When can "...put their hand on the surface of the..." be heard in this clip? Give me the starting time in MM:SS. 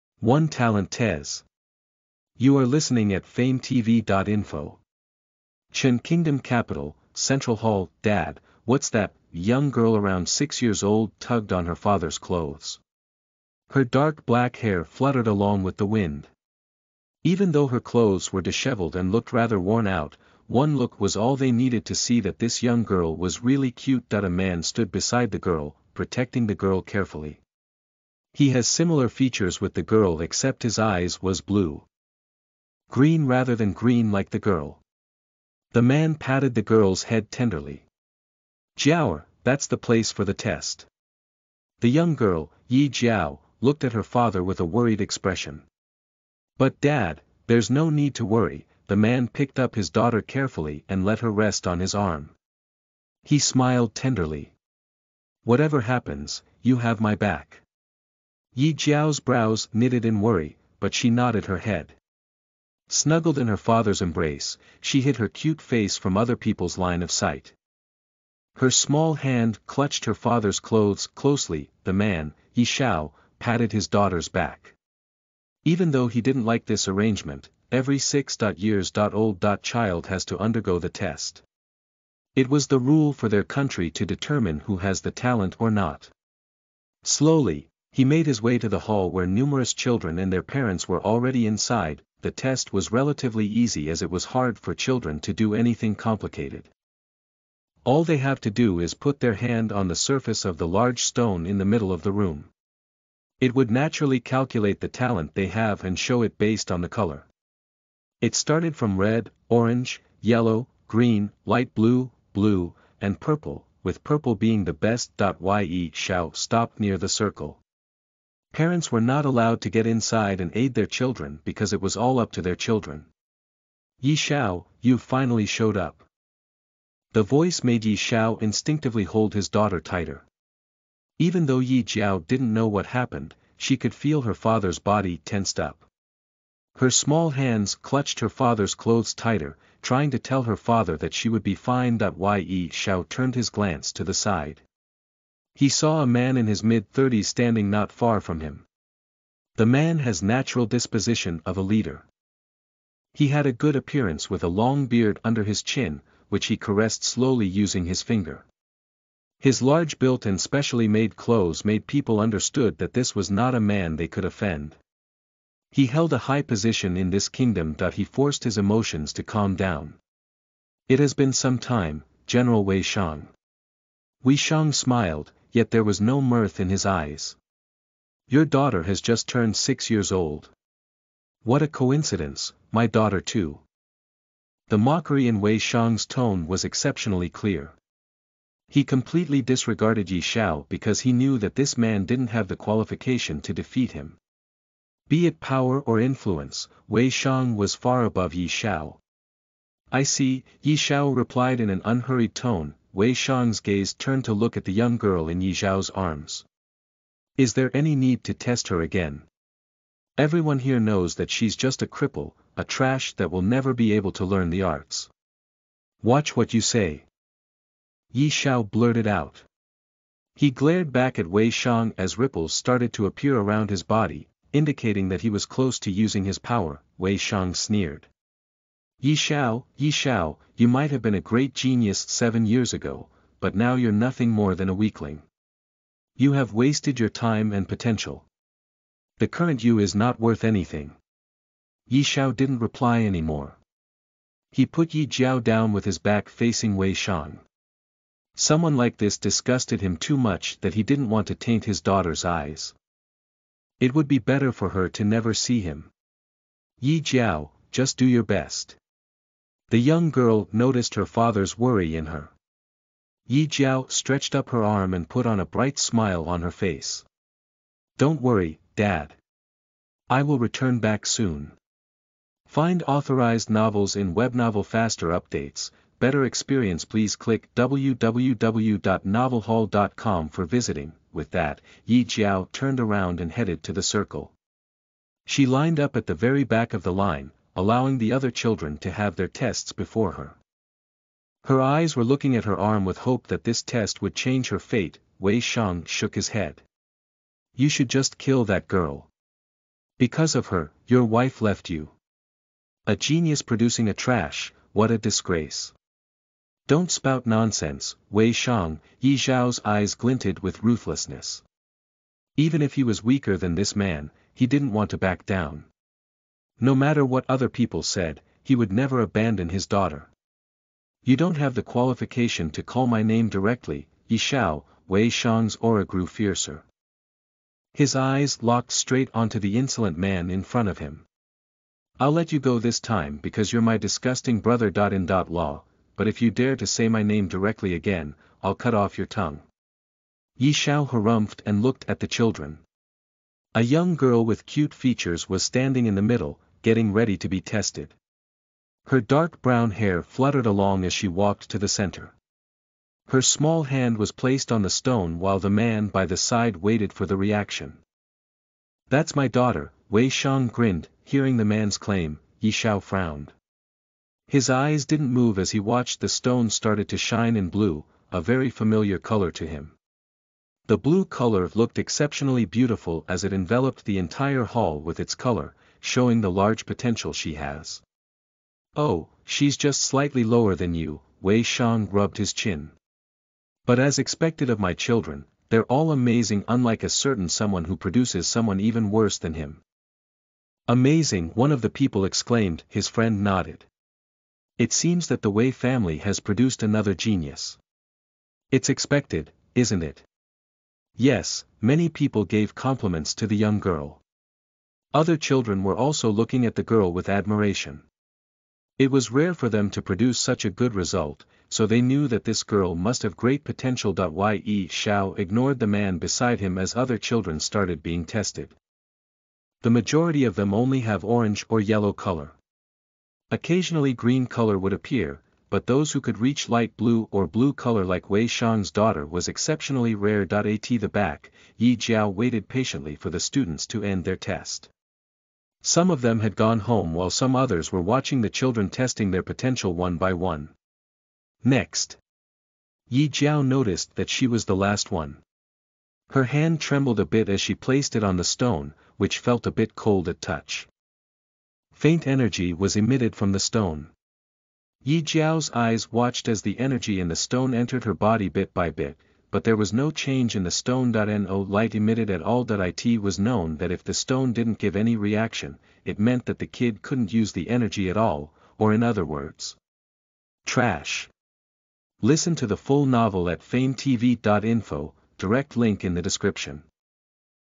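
01:38.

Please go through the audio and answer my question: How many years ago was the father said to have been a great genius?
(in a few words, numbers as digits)
7.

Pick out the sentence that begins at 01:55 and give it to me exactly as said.
Ye shall stop near the circle.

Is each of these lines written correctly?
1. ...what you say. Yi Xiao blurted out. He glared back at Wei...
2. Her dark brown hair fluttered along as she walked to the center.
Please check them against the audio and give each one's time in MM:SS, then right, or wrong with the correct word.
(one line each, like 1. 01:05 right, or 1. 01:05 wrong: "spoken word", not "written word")
1. 03:36 right
2. 05:48 right.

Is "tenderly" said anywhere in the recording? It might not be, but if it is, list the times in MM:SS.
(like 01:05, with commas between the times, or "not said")
00:37, 00:53.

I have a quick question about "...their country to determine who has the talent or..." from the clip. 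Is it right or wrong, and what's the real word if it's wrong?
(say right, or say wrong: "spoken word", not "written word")
right.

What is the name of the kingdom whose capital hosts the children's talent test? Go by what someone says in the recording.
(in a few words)
Chen Kingdom.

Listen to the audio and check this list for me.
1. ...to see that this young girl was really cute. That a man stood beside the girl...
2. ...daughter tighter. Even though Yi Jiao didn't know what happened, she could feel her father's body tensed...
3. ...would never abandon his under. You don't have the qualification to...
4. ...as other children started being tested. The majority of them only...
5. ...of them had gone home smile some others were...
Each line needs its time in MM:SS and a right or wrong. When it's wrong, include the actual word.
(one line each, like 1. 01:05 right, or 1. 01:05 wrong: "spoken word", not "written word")
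1. 00:21 right
2. 02:09 right
3. 05:18 wrong: "daughter", not "under"
4. 06:56 right
5. 07:15 wrong: "while", not "smile".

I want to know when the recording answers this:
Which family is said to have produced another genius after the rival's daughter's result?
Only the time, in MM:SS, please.
06:35.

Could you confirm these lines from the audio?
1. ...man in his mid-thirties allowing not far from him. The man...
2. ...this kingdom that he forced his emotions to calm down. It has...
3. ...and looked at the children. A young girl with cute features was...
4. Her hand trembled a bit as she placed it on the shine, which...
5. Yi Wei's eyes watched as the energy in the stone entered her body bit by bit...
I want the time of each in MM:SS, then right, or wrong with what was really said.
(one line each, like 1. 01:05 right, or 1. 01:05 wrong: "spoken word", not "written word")
1. 02:26 wrong: "standing", not "allowing"
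2. 02:47 right
3. 05:41 right
4. 07:26 wrong: "stone", not "shine"
5. 07:34 wrong: "Jiao", not "Wei".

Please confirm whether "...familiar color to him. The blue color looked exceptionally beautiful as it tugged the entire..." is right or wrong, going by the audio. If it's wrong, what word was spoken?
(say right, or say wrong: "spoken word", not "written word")
wrong: "enveloped", not "tugged".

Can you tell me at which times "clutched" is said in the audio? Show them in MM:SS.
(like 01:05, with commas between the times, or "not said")
01:09, 02:17.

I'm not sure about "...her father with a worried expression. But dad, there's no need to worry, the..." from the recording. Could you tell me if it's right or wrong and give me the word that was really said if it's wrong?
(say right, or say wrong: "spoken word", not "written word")
right.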